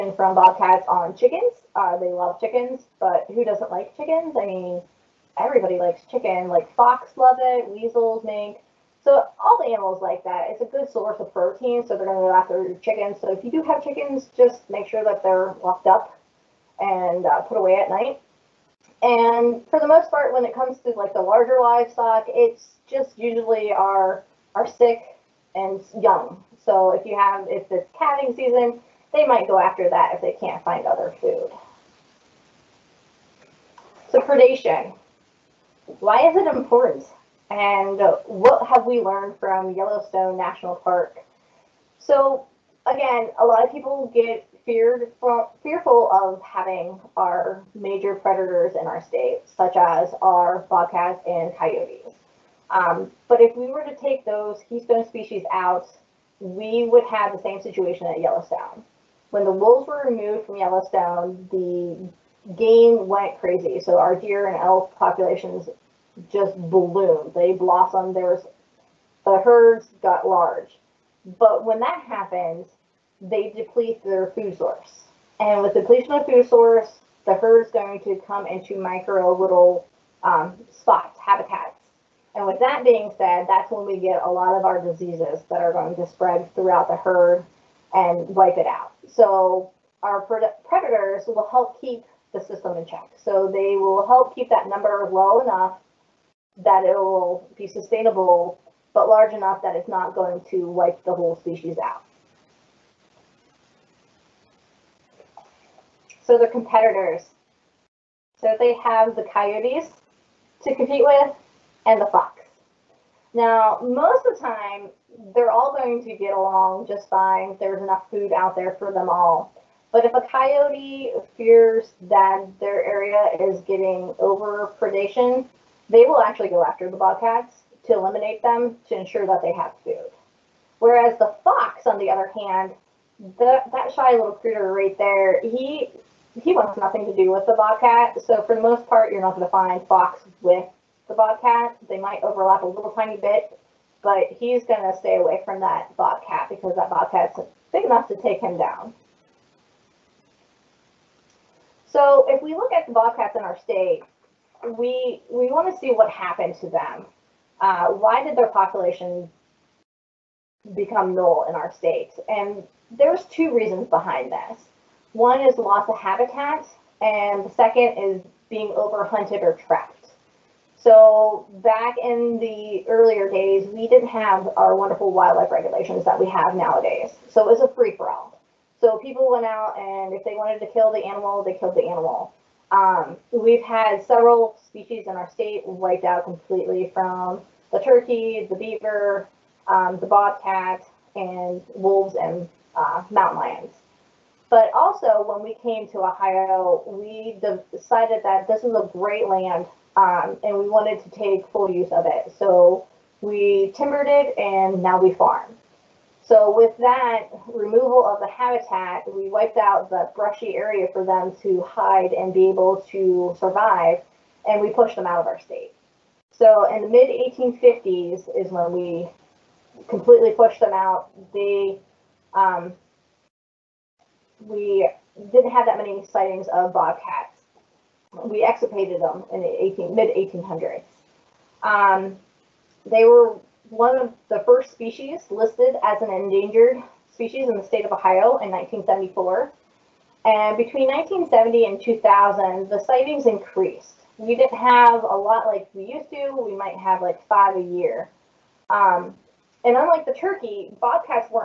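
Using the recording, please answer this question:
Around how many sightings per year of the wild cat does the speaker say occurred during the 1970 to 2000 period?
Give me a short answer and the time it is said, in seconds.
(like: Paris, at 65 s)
5, at 247 s.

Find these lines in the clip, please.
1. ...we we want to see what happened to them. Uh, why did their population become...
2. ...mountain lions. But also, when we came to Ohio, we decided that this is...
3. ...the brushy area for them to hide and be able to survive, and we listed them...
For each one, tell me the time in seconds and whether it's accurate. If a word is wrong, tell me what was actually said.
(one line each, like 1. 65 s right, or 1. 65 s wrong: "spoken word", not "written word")
1. 154 s right
2. 193 s right
3. 209 s wrong: "pushed", not "listed".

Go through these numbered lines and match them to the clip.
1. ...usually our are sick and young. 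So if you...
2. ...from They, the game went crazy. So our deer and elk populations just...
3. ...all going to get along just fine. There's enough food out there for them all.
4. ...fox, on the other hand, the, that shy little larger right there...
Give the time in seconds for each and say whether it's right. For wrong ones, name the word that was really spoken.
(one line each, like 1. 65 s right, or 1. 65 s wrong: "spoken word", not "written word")
1. 23 s right
2. 60 s wrong: "Yellowstone", not "They"
3. 115 s right
4. 131 s wrong: "critter", not "larger".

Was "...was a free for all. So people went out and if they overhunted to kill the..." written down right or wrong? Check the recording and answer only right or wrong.
wrong.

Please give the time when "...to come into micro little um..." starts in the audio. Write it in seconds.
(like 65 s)
77 s.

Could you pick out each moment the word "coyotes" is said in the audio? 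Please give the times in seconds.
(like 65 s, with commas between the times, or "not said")
51 s, 109 s, 120 s.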